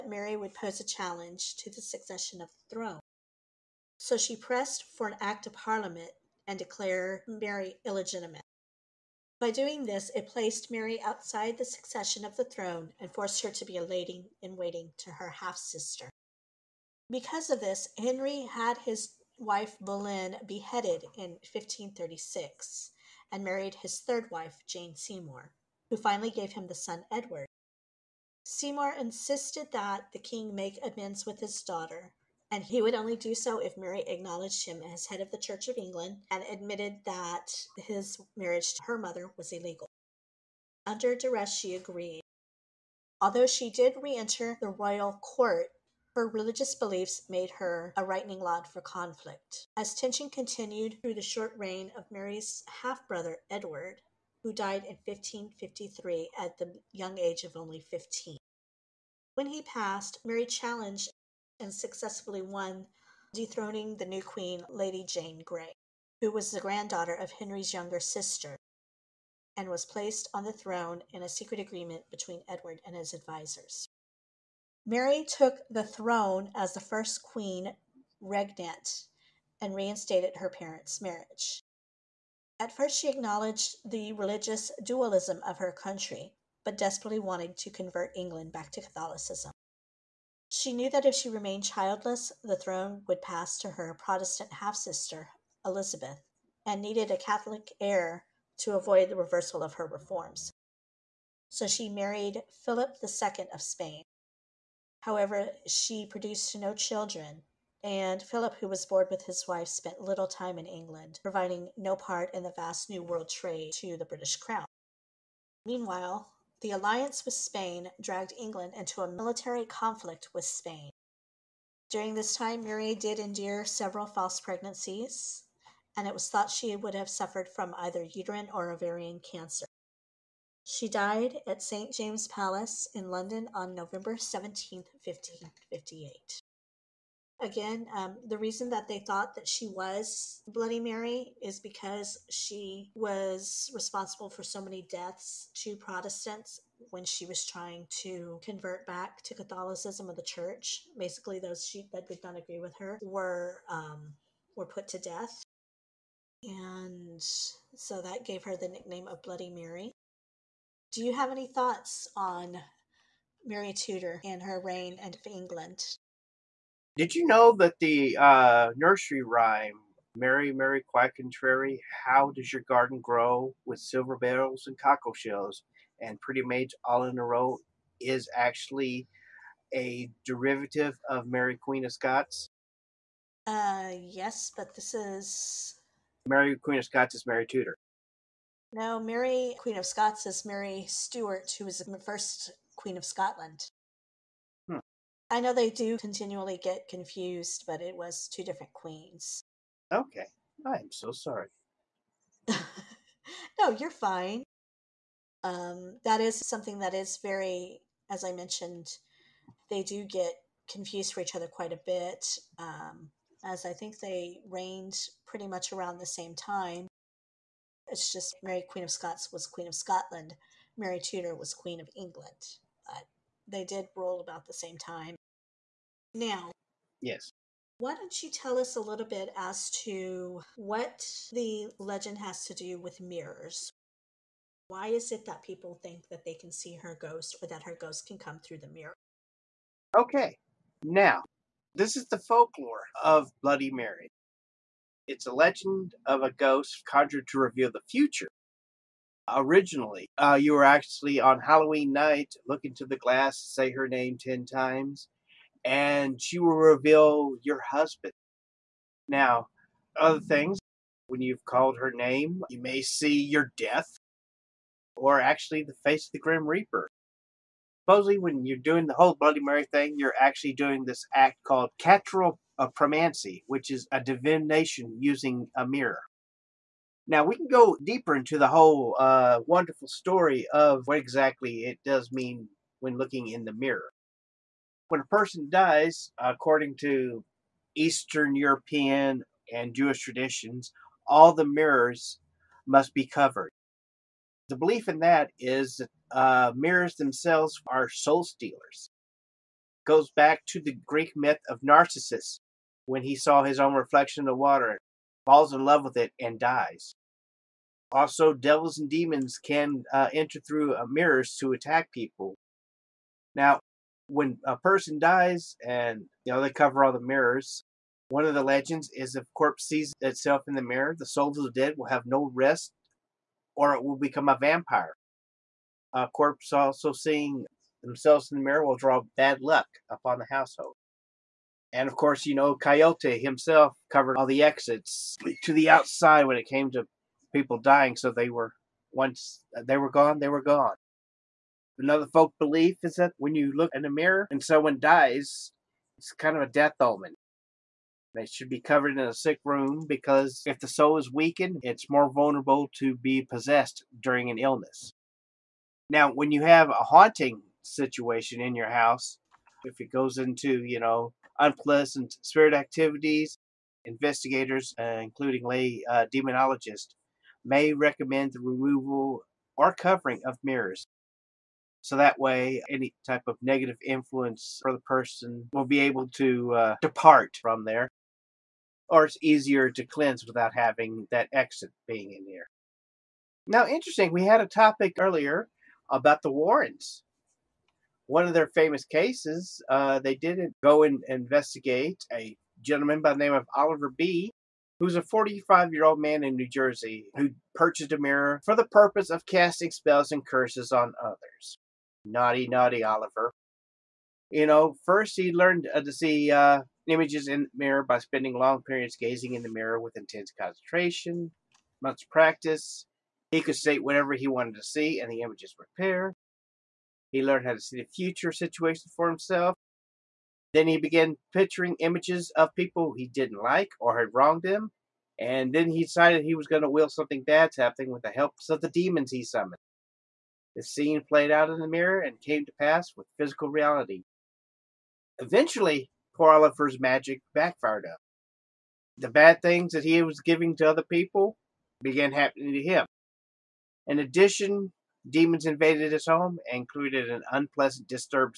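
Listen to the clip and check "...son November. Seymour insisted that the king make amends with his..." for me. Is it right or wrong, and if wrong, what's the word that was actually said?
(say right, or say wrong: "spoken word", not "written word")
wrong: "Edward", not "November".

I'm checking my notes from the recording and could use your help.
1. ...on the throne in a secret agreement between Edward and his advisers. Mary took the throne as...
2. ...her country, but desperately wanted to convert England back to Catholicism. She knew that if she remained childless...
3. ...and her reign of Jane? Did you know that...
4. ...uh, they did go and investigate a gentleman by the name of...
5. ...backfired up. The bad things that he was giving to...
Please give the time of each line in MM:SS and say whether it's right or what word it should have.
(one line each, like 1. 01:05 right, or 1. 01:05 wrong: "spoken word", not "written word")
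1. 01:10 right
2. 01:25 right
3. 02:44 wrong: "England", not "Jane"
4. 06:29 right
5. 07:17 right.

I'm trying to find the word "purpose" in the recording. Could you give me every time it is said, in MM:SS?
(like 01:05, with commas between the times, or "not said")
06:38.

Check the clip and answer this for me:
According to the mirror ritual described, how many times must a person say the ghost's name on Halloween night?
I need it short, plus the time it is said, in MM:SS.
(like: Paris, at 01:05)
10, at 04:14.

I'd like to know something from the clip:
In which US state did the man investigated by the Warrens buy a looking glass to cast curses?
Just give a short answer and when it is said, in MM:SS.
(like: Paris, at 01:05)
New Jersey, at 06:36.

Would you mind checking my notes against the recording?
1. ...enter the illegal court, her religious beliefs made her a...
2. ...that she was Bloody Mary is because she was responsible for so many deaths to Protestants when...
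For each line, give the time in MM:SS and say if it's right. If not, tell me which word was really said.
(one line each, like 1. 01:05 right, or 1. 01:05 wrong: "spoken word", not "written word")
1. 00:44 wrong: "royal", not "illegal"
2. 02:19 right.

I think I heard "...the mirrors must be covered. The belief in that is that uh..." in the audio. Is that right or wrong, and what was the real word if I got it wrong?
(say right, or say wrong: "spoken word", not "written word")
right.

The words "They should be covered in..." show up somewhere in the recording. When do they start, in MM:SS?
05:48.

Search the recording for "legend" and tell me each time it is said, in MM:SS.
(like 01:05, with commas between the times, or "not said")
03:51, 04:05, 05:18.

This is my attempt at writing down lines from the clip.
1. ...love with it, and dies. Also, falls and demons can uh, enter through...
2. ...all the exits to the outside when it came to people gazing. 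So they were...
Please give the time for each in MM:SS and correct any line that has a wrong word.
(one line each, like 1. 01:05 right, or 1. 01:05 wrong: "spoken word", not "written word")
1. 05:05 wrong: "devils", not "falls"
2. 05:34 wrong: "dying", not "gazing".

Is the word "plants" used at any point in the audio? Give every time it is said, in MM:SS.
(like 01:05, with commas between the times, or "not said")
not said.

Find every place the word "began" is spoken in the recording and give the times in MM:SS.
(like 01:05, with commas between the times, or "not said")
07:00, 07:21.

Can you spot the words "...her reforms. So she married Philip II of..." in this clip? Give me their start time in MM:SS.
01:39.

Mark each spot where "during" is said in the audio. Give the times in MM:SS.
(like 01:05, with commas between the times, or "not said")
02:01, 05:54.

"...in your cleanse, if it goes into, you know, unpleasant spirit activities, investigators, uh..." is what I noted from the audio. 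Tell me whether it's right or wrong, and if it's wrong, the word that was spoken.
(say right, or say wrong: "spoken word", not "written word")
wrong: "house", not "cleanse".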